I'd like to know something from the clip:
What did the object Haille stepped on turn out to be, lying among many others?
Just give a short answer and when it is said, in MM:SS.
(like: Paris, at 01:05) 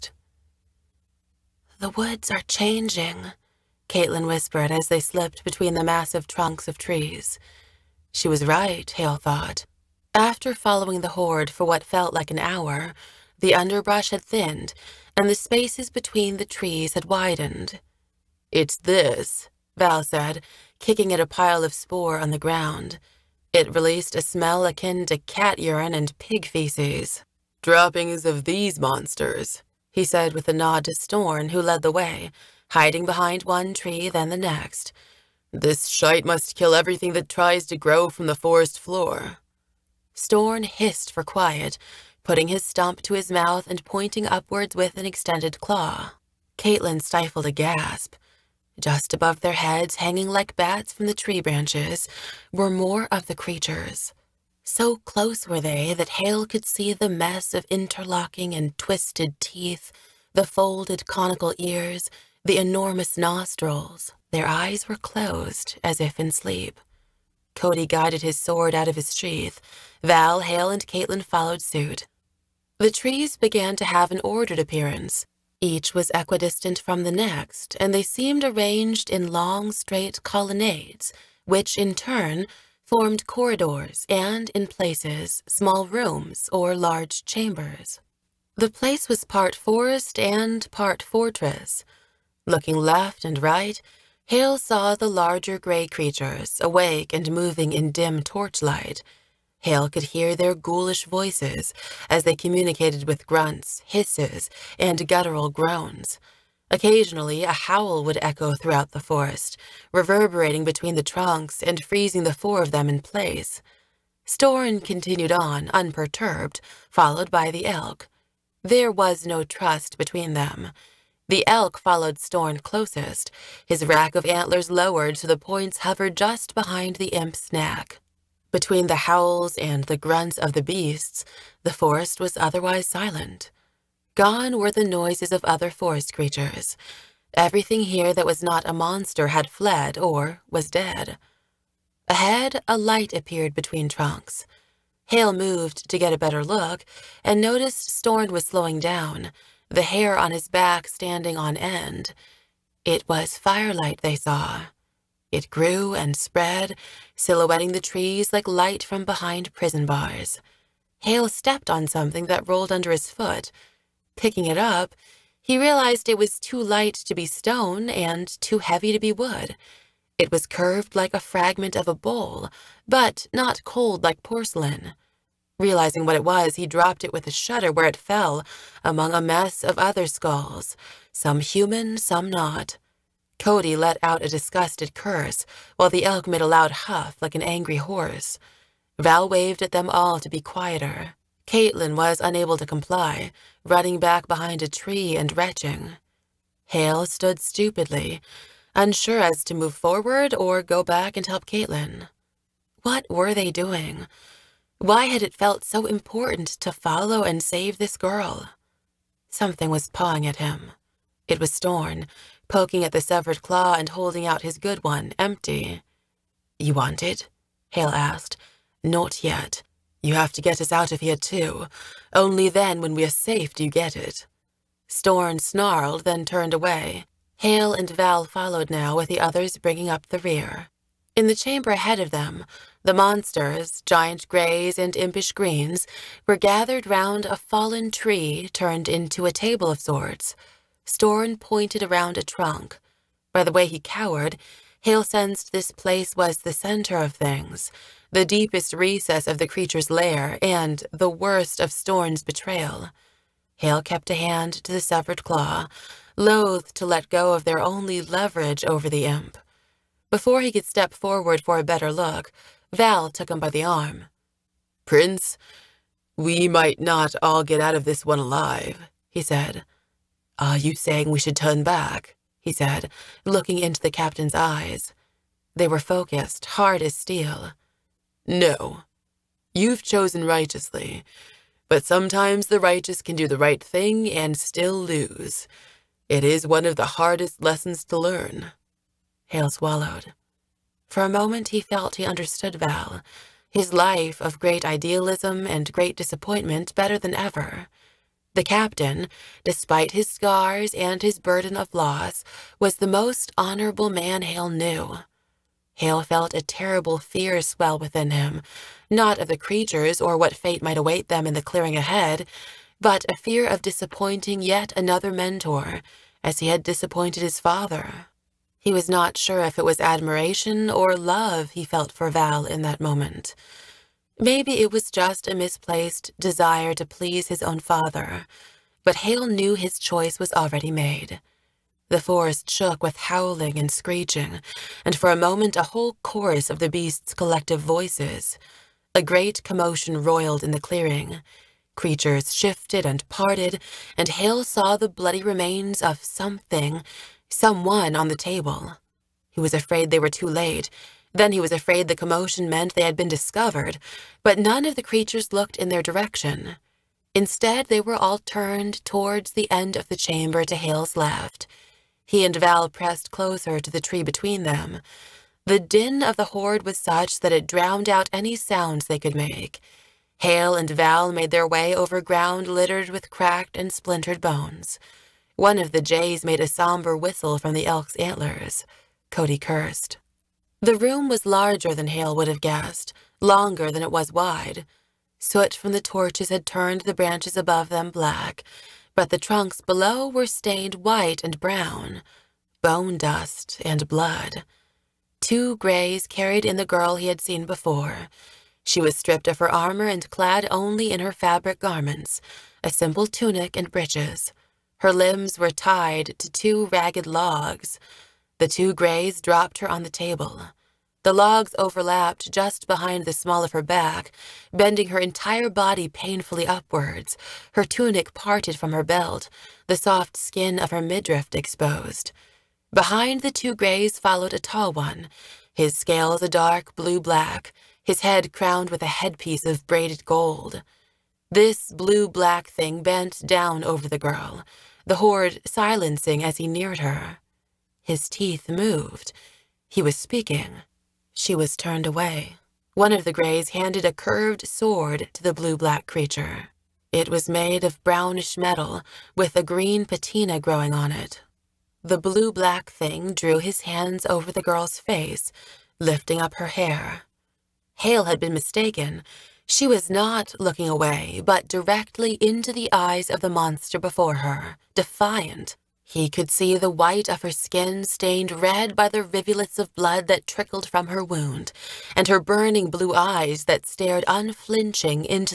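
skulls, at 03:00.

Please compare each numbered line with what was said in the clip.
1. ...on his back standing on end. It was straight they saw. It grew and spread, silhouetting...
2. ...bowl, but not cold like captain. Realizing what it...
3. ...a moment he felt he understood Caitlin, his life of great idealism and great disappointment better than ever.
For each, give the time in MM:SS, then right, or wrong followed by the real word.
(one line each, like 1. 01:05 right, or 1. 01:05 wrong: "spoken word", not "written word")
1. 02:30 wrong: "firelight", not "straight"
2. 02:51 wrong: "porcelain", not "captain"
3. 04:51 wrong: "Val", not "Caitlin".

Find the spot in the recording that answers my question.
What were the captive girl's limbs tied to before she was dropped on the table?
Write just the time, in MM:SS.
06:46.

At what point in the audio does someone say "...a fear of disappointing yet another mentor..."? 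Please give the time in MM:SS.
05:13.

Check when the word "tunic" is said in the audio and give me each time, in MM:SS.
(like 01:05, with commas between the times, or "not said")
06:43, 06:57.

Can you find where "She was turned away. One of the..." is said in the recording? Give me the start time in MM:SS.
07:21.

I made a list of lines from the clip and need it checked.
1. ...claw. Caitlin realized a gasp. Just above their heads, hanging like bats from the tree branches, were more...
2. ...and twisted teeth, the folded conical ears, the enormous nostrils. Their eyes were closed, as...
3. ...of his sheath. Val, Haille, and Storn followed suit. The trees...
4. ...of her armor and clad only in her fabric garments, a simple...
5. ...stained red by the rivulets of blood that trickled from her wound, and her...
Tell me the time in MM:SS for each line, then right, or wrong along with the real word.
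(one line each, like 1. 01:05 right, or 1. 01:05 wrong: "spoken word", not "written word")
1. 00:45 wrong: "stifled", not "realized"
2. 00:58 right
3. 01:08 wrong: "Caitlin", not "Storn"
4. 06:39 right
5. 07:47 right.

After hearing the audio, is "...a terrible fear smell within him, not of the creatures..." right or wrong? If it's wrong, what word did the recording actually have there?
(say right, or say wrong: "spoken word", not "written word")
wrong: "swell", not "smell".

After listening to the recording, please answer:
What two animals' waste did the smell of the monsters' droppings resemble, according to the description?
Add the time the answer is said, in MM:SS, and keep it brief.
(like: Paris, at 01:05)
cat urine and pig feces, at 00:25.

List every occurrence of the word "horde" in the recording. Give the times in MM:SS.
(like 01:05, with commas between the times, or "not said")
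00:11, 06:06, 07:14.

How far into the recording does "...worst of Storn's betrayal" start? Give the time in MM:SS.
04:11.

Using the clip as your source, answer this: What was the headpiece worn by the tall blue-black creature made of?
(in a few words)
braided gold.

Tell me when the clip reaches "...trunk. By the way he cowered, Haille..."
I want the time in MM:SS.
04:02.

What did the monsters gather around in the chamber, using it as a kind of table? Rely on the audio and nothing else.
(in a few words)
a fallen tree.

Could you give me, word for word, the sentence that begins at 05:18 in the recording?
He was not sure if it was admiration or love he felt for Val in that moment.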